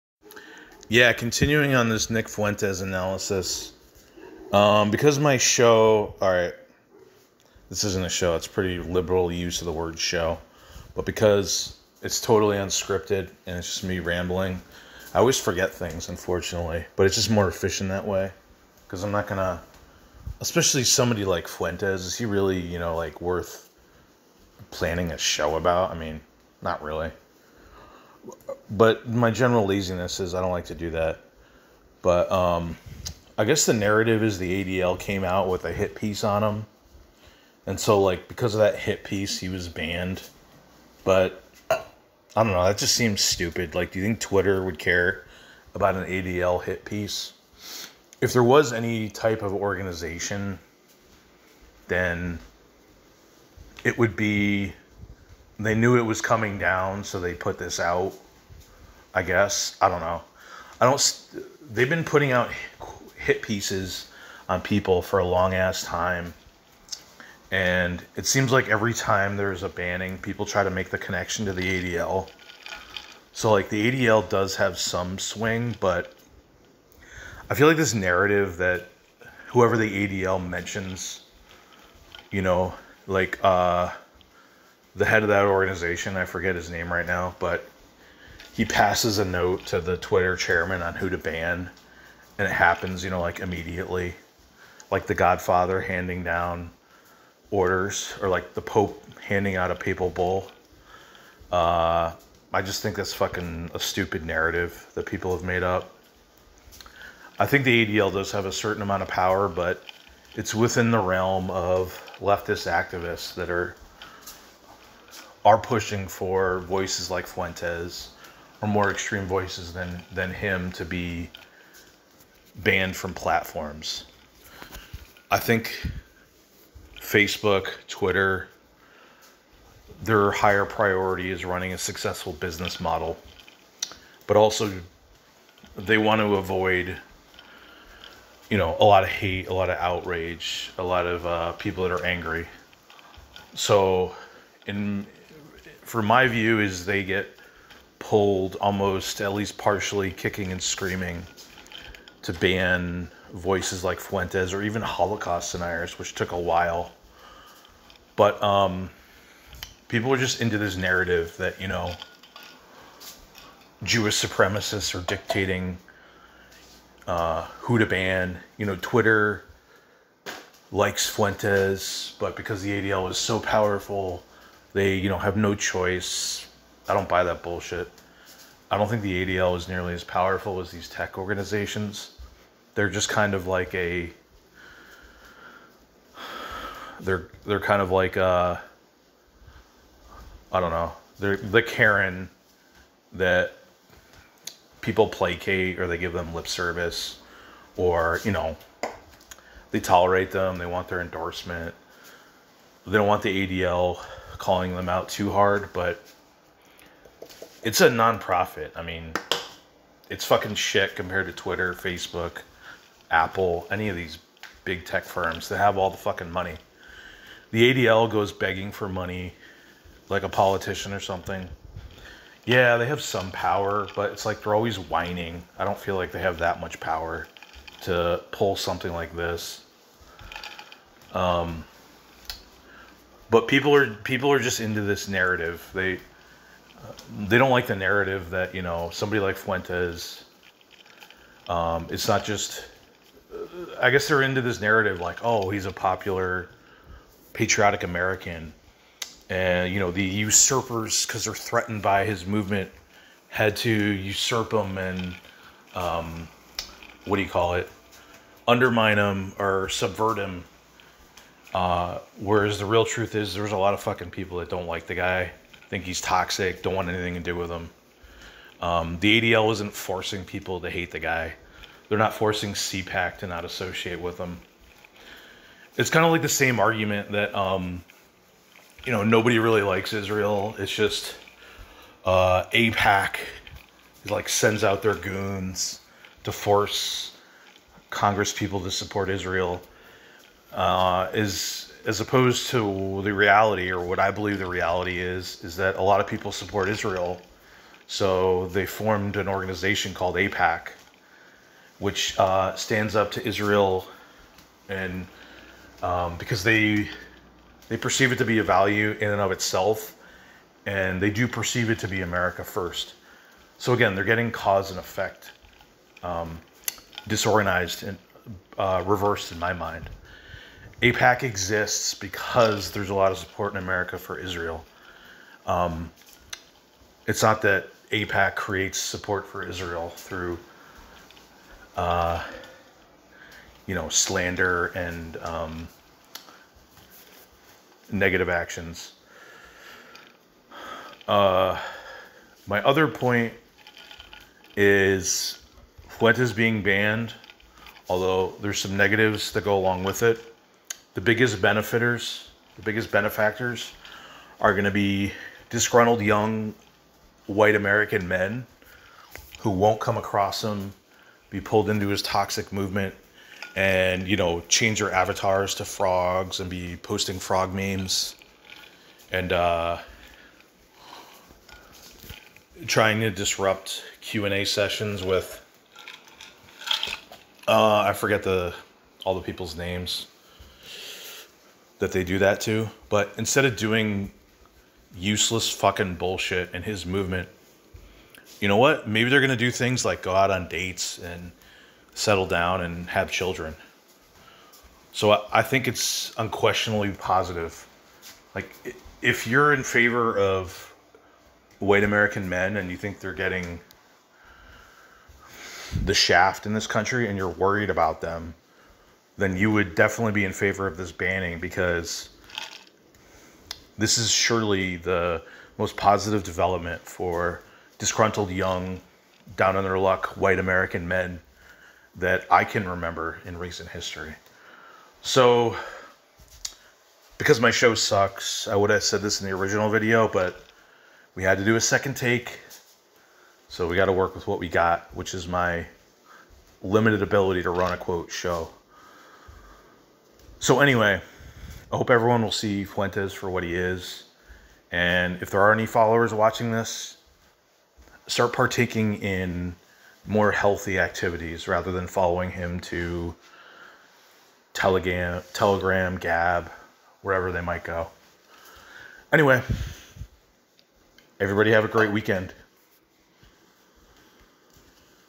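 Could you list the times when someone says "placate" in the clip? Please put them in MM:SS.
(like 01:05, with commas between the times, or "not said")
03:15.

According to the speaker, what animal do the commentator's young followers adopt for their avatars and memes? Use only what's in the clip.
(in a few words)
frogs.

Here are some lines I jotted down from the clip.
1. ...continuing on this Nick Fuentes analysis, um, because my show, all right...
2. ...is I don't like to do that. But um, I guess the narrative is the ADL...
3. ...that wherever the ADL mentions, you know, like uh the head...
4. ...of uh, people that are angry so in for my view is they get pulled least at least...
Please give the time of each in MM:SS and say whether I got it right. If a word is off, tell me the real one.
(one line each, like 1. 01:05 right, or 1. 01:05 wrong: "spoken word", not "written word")
1. 00:01 right
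2. 00:30 right
3. 01:18 wrong: "whoever", not "wherever"
4. 02:21 wrong: "almost", not "least".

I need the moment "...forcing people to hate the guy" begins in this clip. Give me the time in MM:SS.
04:29.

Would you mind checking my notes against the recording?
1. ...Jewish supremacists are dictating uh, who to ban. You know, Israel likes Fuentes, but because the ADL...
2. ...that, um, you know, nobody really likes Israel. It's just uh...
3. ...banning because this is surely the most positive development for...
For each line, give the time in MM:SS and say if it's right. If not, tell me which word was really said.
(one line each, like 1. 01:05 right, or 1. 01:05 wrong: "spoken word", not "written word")
1. 02:43 wrong: "Twitter", not "Israel"
2. 04:37 right
3. 06:50 right.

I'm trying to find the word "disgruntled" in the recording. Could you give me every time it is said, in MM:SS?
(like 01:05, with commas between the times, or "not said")
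05:55, 06:57.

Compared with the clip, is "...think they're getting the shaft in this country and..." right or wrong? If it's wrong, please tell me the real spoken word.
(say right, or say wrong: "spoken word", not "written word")
right.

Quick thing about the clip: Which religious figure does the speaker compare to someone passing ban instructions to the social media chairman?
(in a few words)
the Pope.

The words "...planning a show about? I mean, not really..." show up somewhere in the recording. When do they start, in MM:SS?
00:24.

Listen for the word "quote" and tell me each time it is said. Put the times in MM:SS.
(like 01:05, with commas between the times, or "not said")
07:17.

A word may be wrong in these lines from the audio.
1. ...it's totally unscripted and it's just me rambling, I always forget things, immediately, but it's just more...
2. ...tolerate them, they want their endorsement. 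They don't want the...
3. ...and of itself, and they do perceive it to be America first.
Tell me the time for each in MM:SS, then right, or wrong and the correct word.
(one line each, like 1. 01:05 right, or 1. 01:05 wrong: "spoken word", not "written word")
1. 00:12 wrong: "unfortunately", not "immediately"
2. 03:19 right
3. 05:09 right.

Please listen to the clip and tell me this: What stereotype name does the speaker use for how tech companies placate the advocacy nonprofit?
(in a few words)
Karen.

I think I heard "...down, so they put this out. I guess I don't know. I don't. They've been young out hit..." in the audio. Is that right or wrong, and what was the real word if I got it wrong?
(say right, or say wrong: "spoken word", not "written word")
wrong: "putting", not "young".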